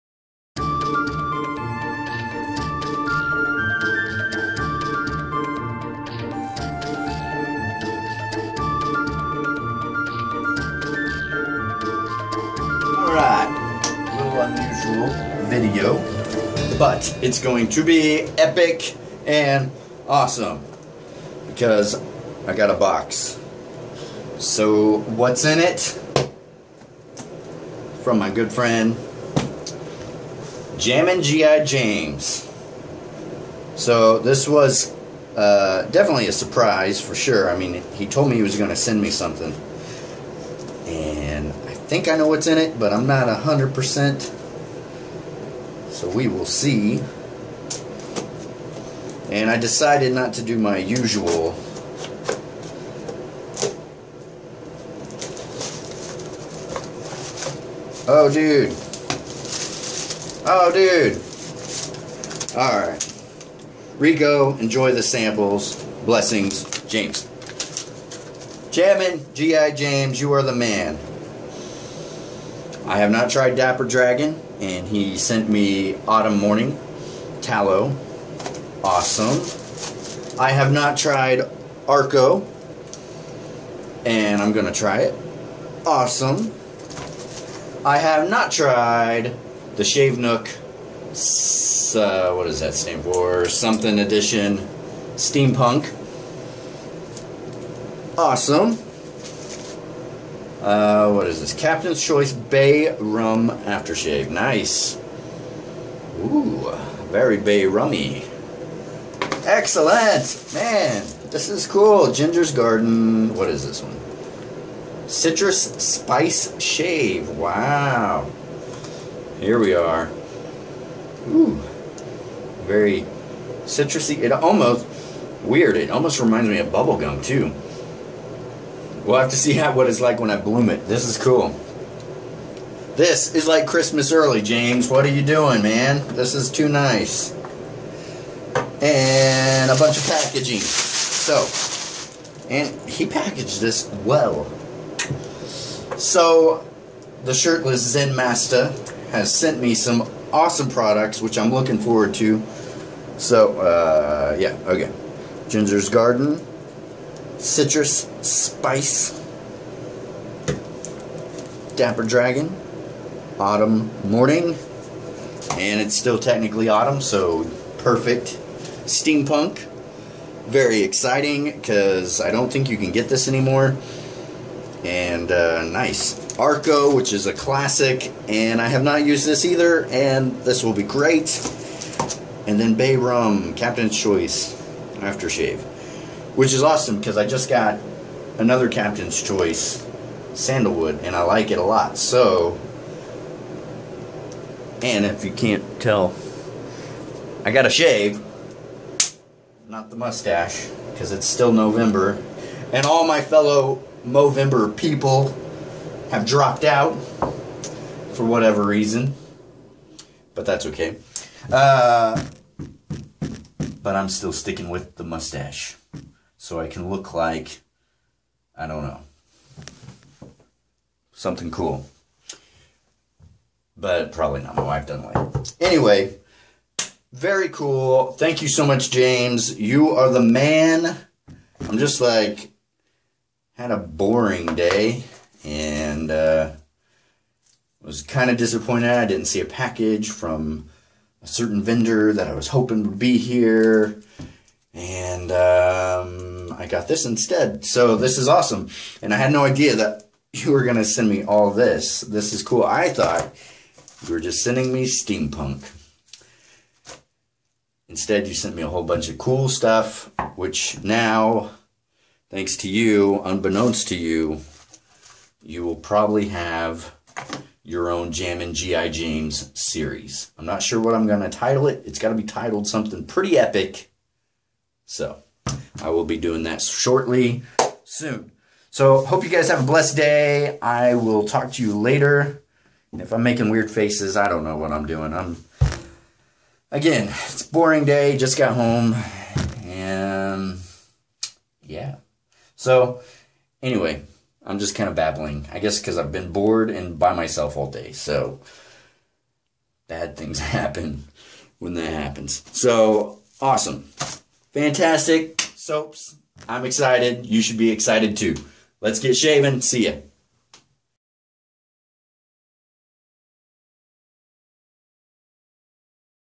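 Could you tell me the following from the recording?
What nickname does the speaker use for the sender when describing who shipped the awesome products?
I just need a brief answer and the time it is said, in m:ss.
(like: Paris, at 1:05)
the shirtless Zen Master, at 2:27.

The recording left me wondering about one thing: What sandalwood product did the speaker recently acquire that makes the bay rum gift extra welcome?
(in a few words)
Captain's Choice sandalwood.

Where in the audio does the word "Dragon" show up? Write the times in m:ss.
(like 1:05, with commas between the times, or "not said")
1:13, 2:42.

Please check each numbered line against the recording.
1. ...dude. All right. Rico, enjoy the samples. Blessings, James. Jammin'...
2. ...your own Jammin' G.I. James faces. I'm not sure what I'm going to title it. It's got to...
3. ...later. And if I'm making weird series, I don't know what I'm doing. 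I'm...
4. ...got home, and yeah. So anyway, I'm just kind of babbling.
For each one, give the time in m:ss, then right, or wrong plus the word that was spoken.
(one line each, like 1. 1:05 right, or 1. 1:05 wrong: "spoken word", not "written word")
1. 1:00 right
2. 4:27 wrong: "series", not "faces"
3. 4:41 wrong: "faces", not "series"
4. 4:48 right.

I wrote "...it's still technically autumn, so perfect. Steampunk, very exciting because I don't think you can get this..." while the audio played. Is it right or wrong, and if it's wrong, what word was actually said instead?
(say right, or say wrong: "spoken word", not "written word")
right.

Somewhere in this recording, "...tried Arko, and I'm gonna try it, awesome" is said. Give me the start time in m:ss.
1:20.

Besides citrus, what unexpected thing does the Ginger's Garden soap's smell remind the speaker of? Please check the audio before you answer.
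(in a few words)
bubblegum.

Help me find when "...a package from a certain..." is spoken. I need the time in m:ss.
3:59.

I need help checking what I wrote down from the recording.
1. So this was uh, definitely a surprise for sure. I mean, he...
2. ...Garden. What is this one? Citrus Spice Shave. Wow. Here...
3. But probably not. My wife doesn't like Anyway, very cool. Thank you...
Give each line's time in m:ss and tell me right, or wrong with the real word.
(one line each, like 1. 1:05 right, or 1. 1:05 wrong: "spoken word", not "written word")
1. 0:33 right
2. 1:52 right
3. 3:43 right.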